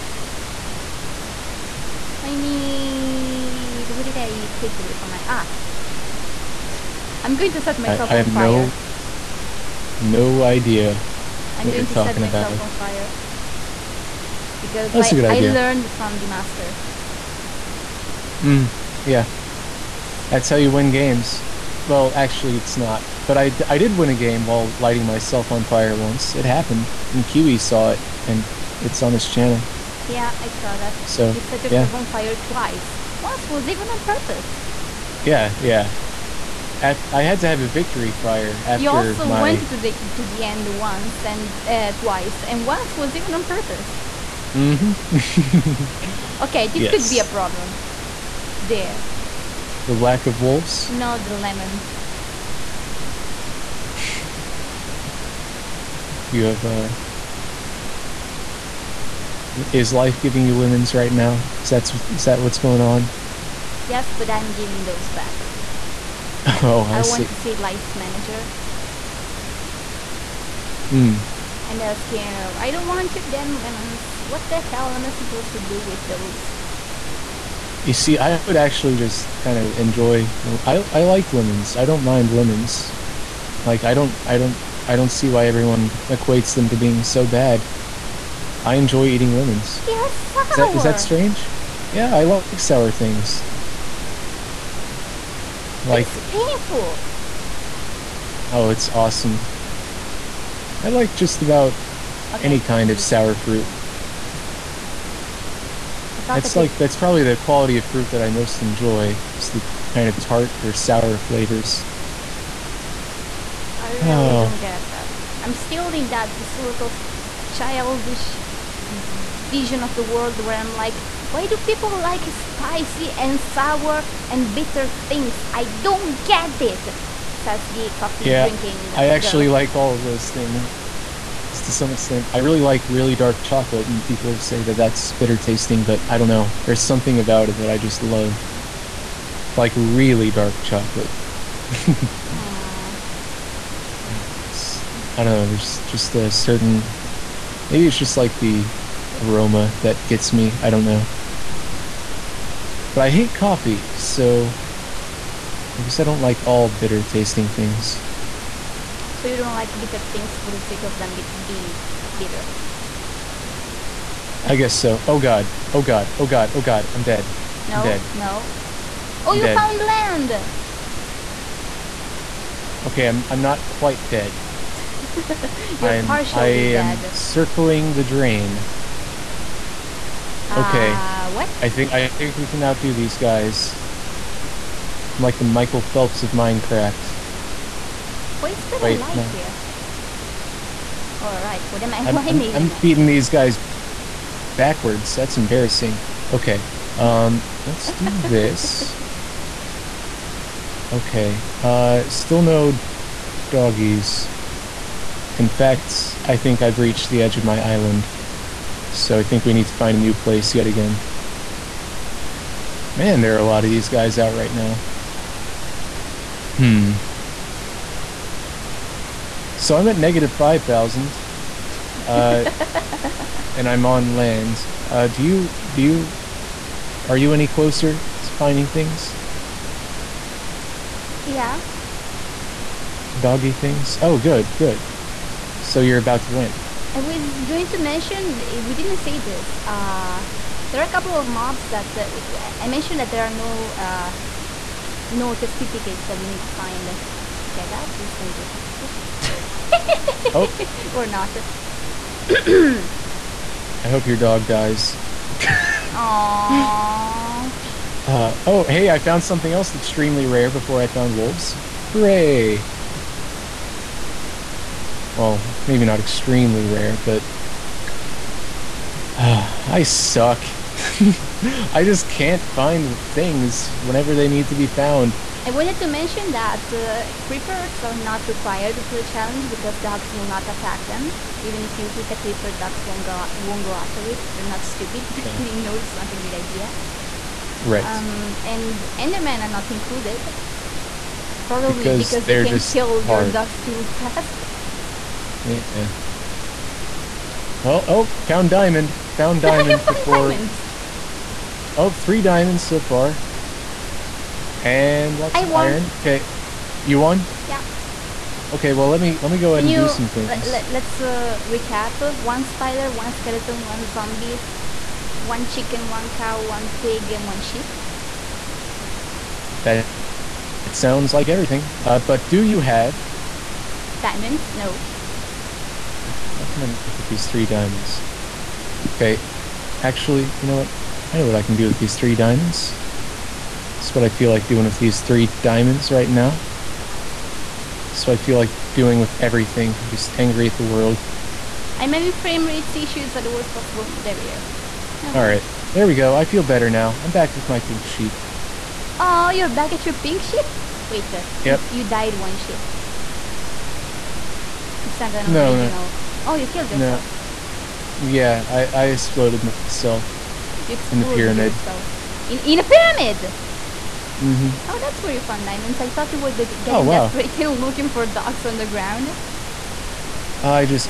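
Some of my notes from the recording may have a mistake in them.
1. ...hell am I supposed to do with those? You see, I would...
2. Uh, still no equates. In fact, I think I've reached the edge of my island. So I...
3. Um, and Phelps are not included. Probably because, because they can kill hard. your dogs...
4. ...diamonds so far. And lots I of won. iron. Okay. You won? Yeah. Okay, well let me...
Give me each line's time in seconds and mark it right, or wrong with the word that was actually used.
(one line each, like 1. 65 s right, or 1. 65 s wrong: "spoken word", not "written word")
1. 74 s right
2. 201 s wrong: "doggies", not "equates"
3. 287 s wrong: "Endermen", not "Phelps"
4. 302 s right.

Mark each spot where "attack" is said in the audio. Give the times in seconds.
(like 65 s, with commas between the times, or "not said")
280 s.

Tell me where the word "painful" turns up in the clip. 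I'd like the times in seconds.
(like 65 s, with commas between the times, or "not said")
96 s, 103 s.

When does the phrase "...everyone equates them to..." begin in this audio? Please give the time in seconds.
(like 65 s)
85 s.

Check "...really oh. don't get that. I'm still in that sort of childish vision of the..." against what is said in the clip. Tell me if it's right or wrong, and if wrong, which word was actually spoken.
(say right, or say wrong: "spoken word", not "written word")
right.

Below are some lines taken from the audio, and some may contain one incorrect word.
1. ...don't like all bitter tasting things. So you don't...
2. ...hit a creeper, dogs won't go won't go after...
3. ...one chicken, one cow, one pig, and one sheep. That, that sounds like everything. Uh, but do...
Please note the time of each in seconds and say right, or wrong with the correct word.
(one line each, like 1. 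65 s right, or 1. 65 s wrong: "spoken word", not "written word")
1. 156 s right
2. 281 s right
3. 315 s right.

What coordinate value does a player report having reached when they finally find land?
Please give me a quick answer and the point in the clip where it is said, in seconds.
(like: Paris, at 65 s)
-5000, at 219 s.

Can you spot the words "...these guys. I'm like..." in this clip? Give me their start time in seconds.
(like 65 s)
182 s.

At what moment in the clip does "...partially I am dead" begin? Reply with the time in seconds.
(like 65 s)
176 s.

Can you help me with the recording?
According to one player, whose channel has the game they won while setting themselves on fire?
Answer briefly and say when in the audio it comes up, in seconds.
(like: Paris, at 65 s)
Kiwi, at 27 s.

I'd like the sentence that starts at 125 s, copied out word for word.
I don't get it, says the coffee yeah, drinking.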